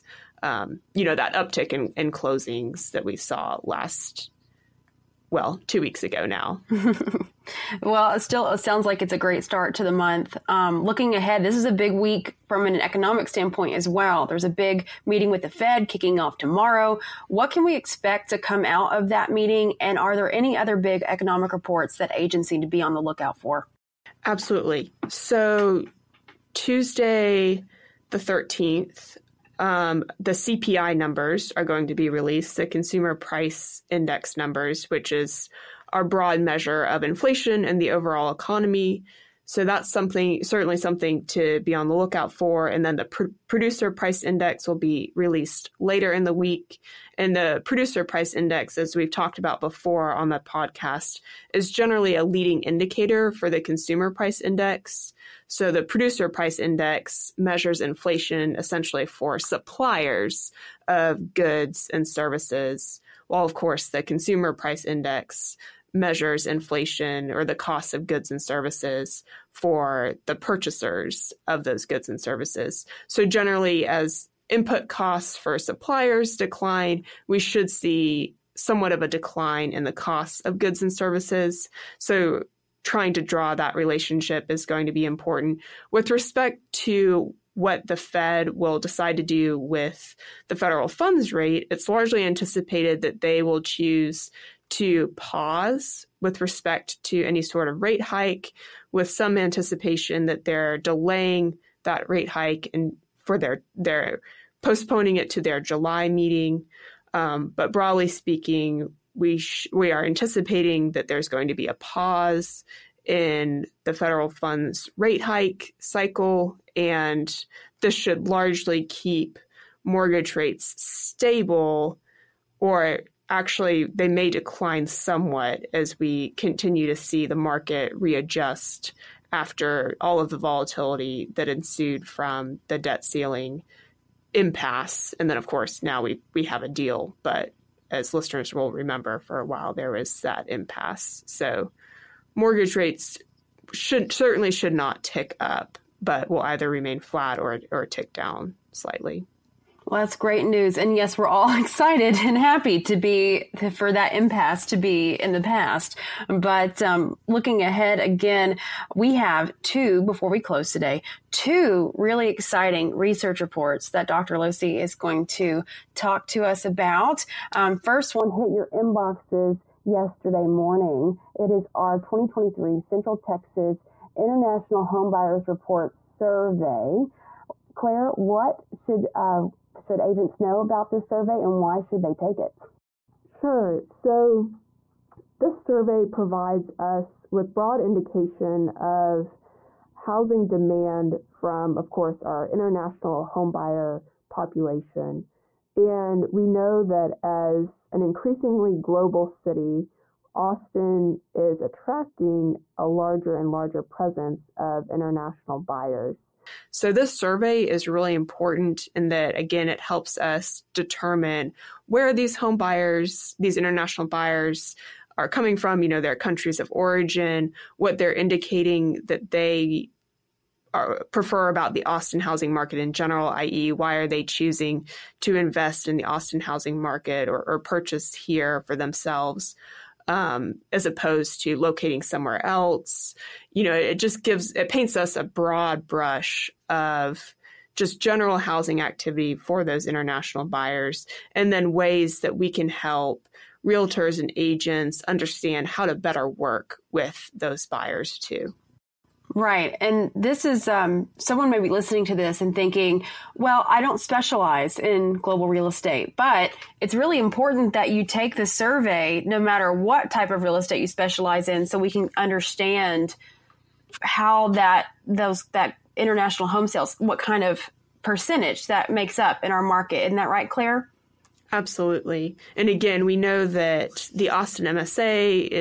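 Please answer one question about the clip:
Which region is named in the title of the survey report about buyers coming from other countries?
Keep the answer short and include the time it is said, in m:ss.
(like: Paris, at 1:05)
Central Texas, at 2:52.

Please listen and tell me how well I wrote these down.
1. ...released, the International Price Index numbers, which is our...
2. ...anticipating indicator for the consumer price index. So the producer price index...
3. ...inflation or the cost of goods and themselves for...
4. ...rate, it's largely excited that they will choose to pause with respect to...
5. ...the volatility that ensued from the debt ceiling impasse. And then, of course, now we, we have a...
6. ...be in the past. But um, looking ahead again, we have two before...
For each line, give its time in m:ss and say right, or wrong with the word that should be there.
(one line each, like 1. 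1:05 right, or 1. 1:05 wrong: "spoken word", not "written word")
1. 0:32 wrong: "Consumer", not "International"
2. 0:52 wrong: "leading", not "anticipating"
3. 1:06 wrong: "services", not "themselves"
4. 1:31 wrong: "anticipated", not "excited"
5. 2:10 right
6. 2:34 right.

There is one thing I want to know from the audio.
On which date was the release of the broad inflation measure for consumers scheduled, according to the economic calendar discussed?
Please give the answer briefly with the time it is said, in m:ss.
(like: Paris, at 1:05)
Tuesday, the 13th, at 0:26.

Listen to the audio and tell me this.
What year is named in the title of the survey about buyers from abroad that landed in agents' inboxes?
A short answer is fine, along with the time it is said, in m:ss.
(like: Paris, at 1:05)
2023, at 2:51.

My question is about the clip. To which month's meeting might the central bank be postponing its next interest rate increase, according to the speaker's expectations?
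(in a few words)
July.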